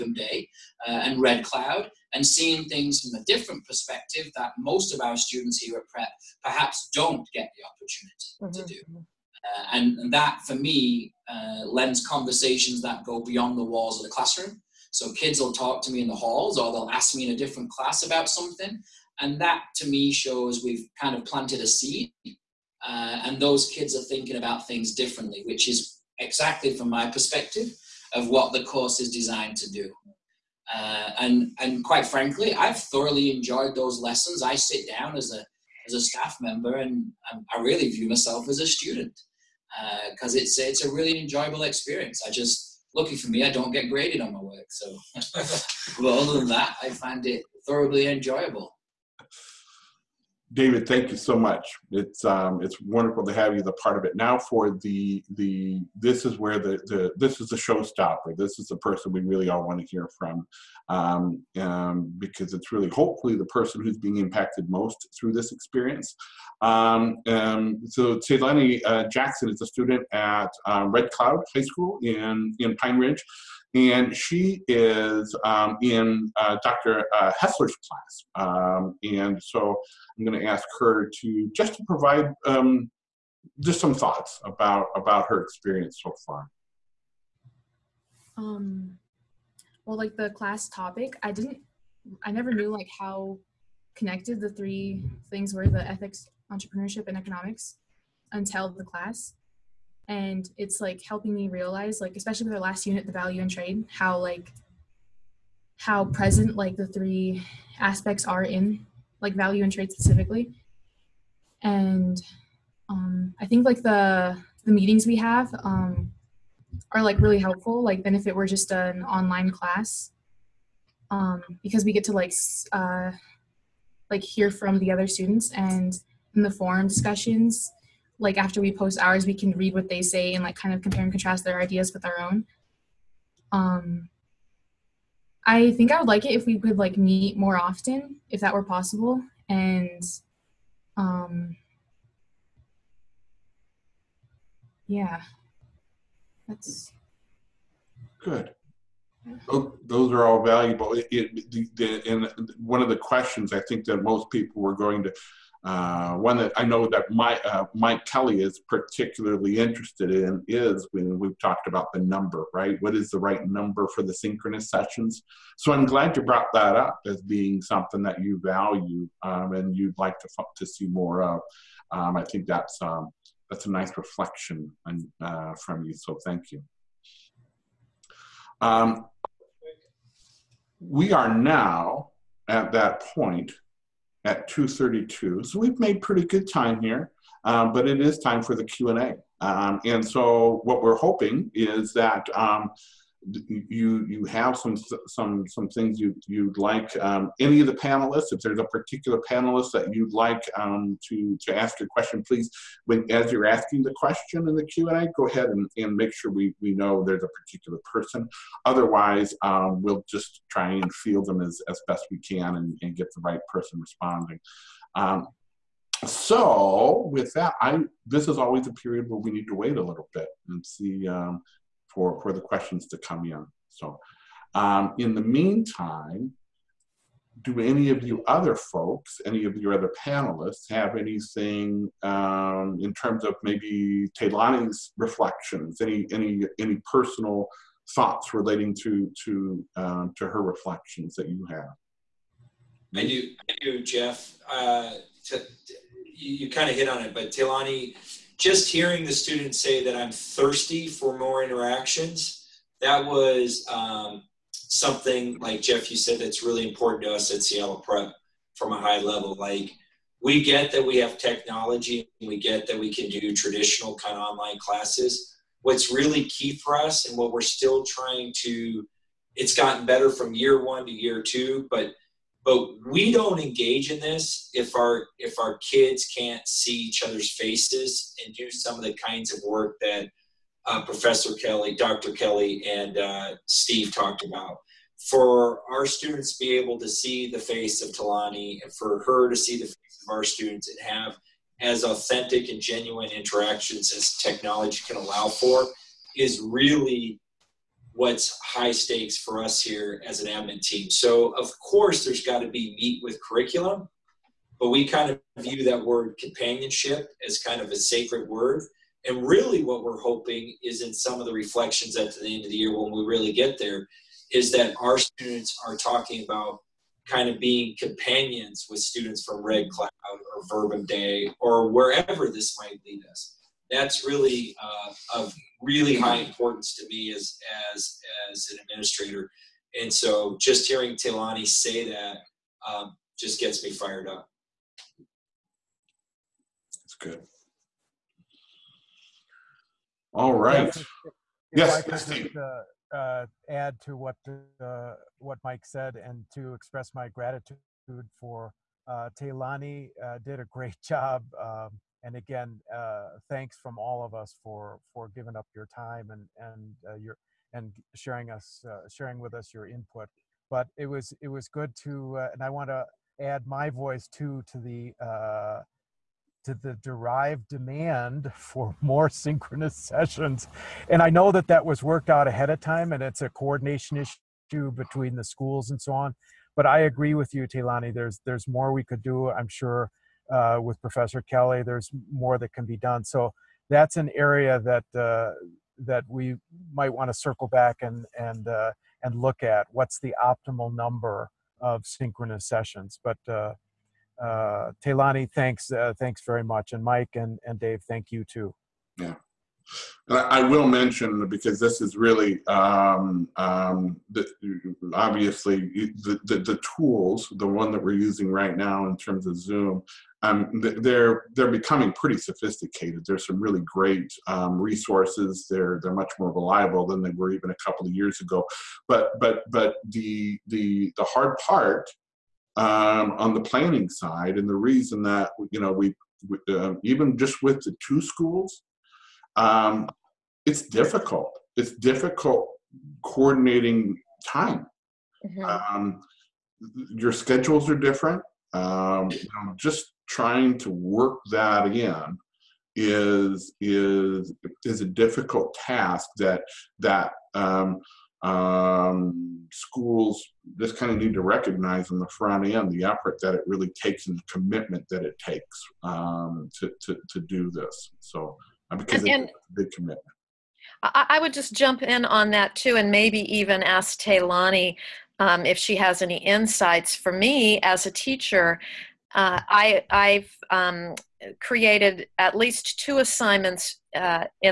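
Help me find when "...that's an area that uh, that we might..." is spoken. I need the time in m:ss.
6:23.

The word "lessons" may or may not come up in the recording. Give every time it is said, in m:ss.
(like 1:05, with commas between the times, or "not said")
0:34.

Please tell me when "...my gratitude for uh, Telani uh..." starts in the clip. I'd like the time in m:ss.
5:46.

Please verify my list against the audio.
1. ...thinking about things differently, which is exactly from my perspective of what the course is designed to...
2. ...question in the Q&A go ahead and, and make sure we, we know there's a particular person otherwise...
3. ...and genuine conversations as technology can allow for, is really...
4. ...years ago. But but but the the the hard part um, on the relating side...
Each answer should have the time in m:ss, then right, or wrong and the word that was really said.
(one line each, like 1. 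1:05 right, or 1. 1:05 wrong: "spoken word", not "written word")
1. 0:24 right
2. 3:23 right
3. 4:52 wrong: "interactions", not "conversations"
4. 6:57 wrong: "planning", not "relating".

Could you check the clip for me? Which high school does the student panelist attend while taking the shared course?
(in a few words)
Red Cloud High School.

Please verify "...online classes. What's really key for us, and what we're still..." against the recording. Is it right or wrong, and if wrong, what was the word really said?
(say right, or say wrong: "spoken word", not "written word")
right.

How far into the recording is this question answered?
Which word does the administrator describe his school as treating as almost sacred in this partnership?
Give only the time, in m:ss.
5:06.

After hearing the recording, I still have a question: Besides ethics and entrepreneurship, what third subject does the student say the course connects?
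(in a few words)
economics.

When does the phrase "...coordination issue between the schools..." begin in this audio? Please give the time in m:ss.
6:13.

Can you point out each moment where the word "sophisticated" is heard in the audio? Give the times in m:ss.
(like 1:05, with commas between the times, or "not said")
6:52.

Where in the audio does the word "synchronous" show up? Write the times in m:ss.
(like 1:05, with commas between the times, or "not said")
2:44, 6:09, 6:31.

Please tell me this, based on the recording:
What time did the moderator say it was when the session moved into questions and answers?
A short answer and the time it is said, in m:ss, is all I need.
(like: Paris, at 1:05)
2:32, at 3:04.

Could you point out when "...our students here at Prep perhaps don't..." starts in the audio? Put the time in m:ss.
0:05.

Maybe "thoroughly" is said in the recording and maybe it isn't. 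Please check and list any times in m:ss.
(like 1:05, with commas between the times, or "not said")
0:32, 0:47.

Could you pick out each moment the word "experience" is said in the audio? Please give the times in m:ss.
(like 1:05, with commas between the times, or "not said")
0:41, 1:05, 1:25.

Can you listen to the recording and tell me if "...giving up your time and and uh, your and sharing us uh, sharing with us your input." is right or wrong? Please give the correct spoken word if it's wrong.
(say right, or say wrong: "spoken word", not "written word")
right.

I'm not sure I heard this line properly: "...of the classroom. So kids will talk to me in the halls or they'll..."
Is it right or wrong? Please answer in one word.
right.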